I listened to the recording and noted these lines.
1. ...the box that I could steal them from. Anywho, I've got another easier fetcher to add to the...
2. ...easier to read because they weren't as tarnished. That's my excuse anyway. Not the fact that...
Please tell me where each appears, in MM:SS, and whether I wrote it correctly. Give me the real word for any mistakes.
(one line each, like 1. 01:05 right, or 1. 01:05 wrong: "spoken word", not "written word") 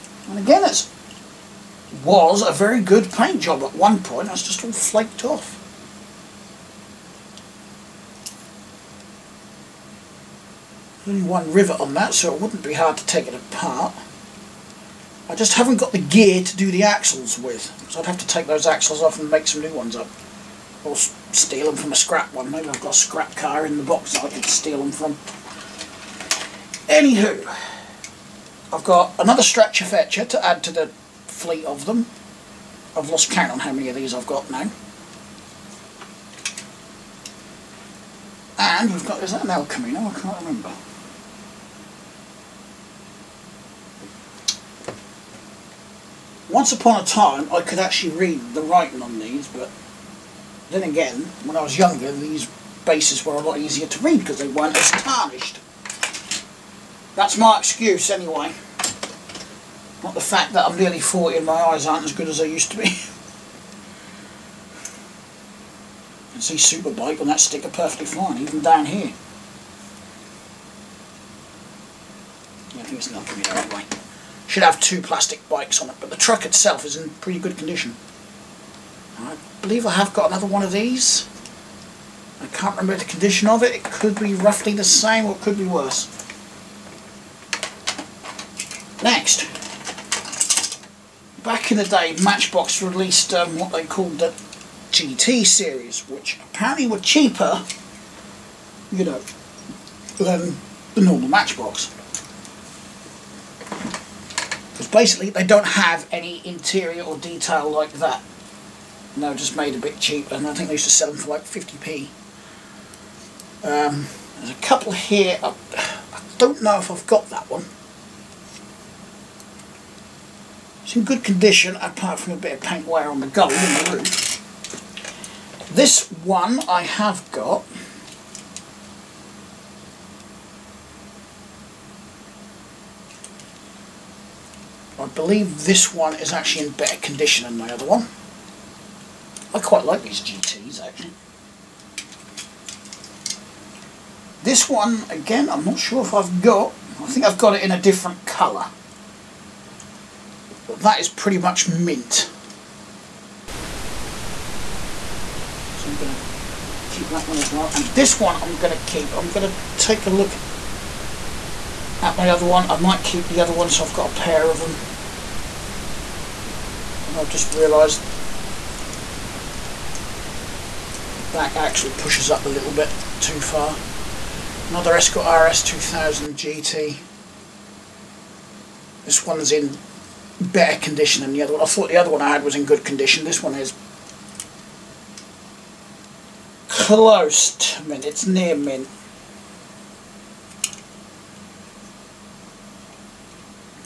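1. 00:23 wrong: "stretcher", not "easier"
2. 00:53 right.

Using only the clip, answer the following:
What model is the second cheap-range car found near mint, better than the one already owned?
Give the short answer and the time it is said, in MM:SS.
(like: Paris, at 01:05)
Escort RS 2000, at 02:54.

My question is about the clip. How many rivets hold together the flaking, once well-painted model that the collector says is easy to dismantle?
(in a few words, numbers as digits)
1.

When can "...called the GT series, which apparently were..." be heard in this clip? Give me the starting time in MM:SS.
01:33.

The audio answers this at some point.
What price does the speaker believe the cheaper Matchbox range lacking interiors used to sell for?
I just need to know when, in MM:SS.
01:51.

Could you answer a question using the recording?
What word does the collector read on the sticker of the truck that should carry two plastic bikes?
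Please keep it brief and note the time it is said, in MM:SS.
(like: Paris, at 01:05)
Superbike, at 01:06.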